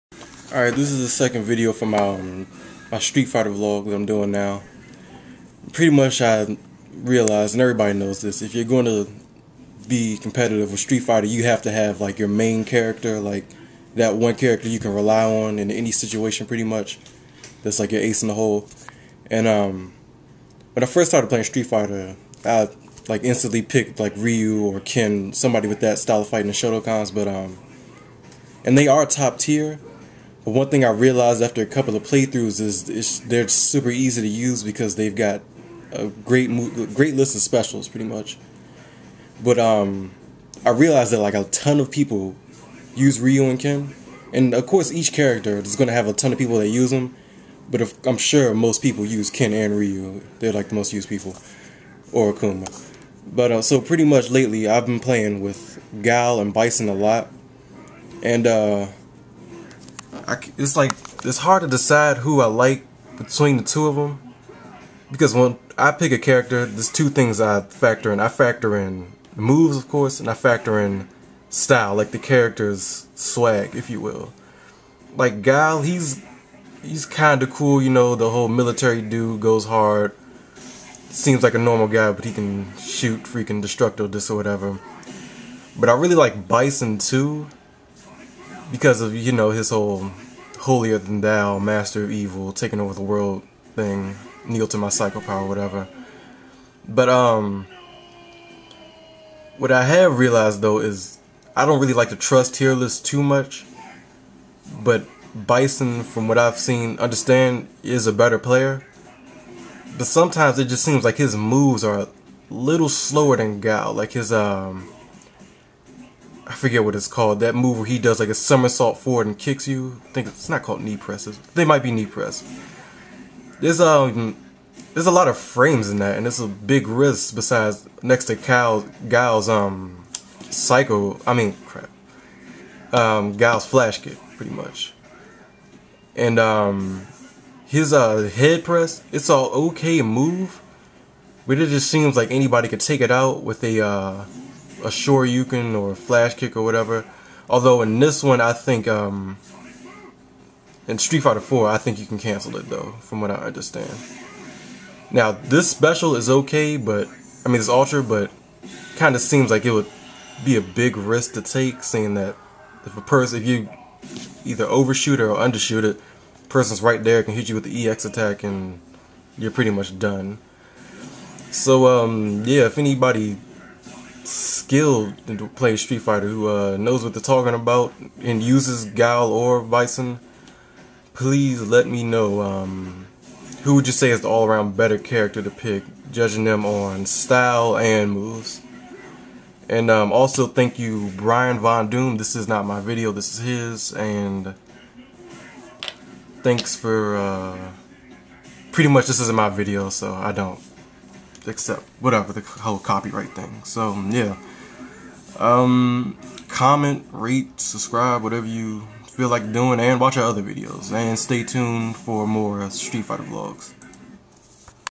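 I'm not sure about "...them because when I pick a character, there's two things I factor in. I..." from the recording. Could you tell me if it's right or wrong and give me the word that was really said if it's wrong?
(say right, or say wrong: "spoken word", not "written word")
right.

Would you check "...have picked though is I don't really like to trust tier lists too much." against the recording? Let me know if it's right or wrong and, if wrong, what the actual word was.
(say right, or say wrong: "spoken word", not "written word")
wrong: "realized", not "picked".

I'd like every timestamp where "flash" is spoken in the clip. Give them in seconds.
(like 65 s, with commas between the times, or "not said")
133 s, 145 s.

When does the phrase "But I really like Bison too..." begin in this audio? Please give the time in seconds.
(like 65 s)
85 s.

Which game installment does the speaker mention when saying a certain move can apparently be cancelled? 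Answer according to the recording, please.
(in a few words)
Street Fighter 4.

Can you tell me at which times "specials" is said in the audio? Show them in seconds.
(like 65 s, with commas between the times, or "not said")
37 s, 155 s.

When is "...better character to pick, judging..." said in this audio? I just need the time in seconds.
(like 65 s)
184 s.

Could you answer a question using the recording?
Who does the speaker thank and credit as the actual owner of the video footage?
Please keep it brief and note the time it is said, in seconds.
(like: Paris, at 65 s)
Brian Von Doom, at 191 s.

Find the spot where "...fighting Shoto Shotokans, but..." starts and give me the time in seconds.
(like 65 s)
26 s.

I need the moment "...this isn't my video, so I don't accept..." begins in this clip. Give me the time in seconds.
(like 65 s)
199 s.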